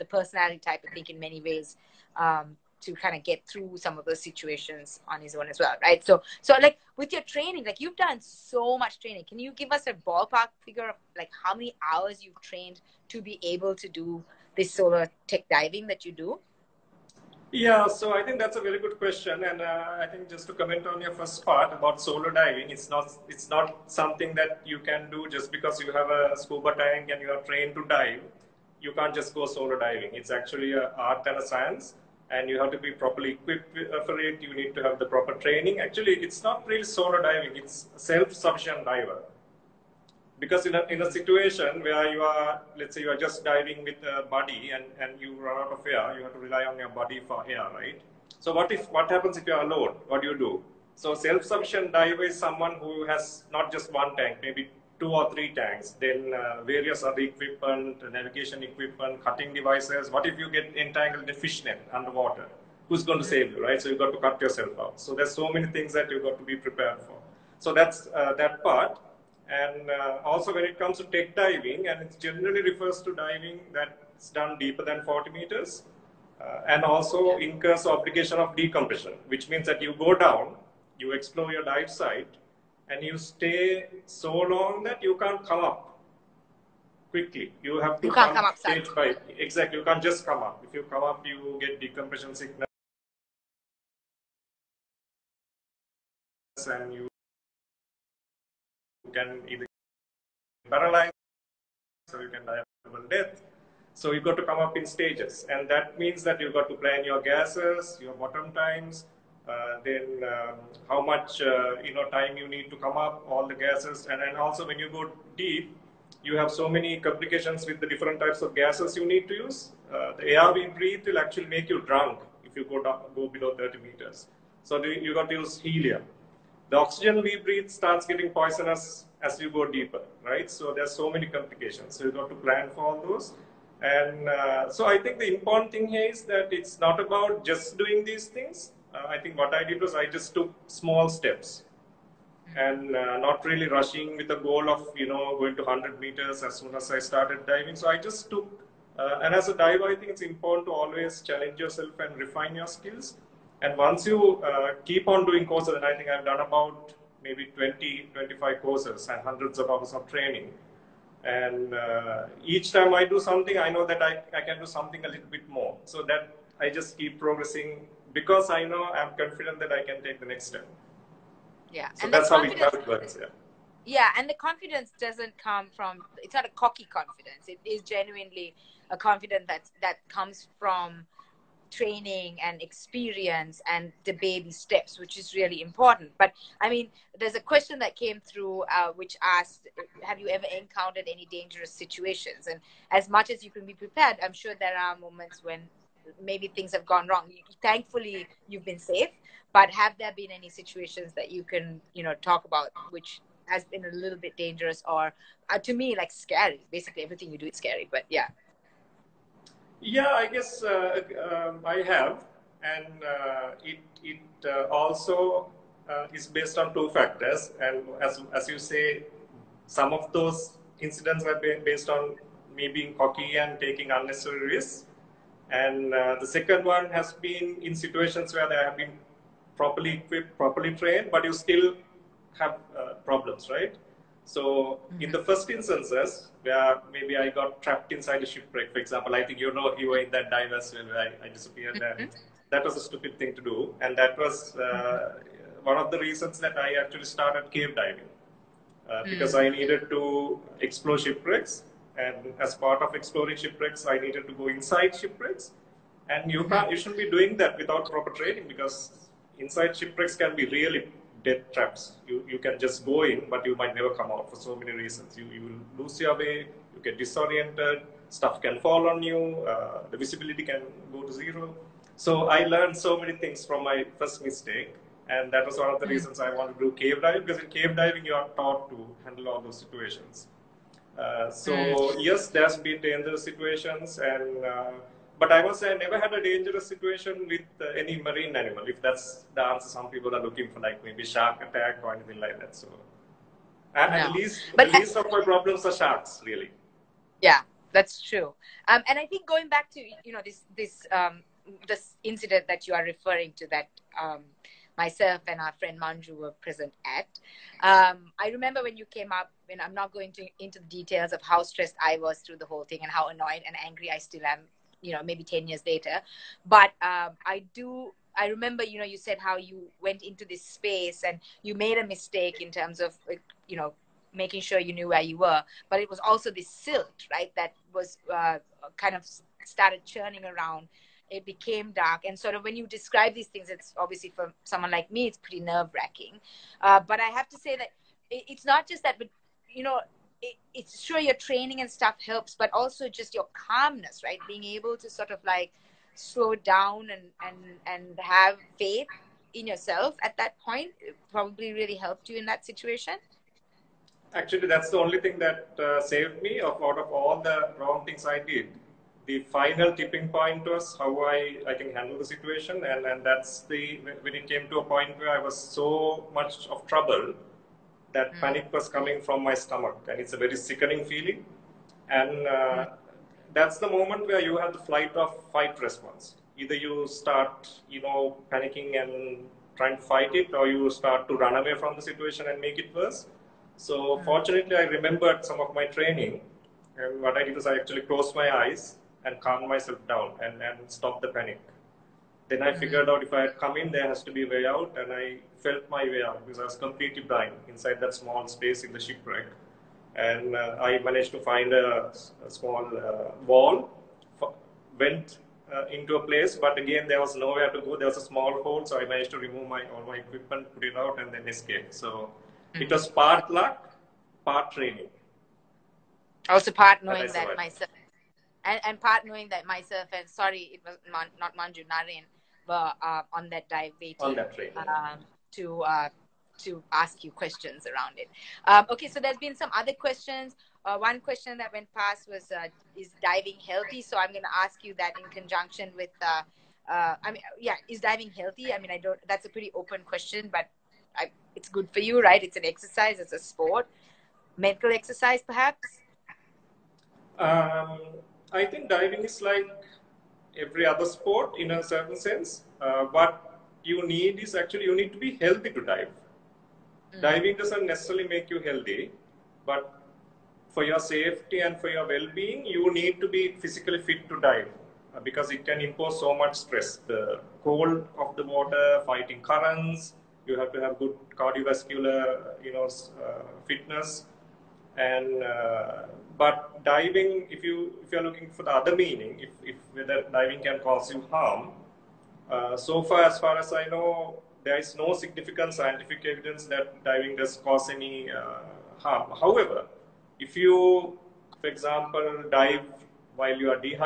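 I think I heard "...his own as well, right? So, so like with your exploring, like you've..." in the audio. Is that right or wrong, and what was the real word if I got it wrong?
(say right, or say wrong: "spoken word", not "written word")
wrong: "training", not "exploring".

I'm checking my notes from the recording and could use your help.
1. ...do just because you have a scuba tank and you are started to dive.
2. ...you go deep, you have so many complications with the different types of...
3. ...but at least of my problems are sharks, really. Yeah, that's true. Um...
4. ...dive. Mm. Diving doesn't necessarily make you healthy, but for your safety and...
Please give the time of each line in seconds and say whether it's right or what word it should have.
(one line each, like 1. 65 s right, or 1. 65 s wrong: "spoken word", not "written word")
1. 25 s wrong: "trained", not "started"
2. 114 s right
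3. 294 s right
4. 455 s right.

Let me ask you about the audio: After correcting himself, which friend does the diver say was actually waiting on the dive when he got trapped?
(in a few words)
Naren.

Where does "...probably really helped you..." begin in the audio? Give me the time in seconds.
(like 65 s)
351 s.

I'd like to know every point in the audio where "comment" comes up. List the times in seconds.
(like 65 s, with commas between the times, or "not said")
20 s.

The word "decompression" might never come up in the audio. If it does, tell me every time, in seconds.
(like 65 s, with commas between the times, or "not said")
78 s, 91 s.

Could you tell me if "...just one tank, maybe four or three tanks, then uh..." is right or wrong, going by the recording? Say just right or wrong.
wrong.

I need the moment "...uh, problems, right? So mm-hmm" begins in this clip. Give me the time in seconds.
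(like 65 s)
232 s.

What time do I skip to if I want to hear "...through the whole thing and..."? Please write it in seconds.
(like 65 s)
312 s.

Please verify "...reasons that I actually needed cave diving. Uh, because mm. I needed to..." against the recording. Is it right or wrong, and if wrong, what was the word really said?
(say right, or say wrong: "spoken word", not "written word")
wrong: "started", not "needed".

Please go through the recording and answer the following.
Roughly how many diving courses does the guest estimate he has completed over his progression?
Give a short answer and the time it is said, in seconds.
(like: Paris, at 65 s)
20 to 25, at 157 s.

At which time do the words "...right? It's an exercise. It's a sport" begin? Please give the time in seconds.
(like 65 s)
442 s.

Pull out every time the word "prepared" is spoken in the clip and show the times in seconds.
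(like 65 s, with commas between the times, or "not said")
66 s, 193 s.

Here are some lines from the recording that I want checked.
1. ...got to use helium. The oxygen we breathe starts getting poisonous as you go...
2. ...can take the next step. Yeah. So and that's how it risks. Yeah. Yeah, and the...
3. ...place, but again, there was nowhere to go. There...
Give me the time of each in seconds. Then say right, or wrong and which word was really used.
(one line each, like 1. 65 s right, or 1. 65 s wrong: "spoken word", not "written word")
1. 125 s right
2. 169 s wrong: "works", not "risks"
3. 406 s right.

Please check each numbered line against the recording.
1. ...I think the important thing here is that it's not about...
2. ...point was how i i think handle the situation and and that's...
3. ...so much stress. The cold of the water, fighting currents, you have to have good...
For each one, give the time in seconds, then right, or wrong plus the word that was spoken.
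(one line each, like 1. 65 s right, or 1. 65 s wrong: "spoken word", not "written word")
1. 134 s right
2. 360 s right
3. 466 s right.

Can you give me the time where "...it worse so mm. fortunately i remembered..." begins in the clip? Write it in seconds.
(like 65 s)
382 s.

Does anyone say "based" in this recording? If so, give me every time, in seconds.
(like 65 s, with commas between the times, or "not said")
216 s, 221 s.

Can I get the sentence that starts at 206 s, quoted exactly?
Basically, everything you do is scary, but yeah.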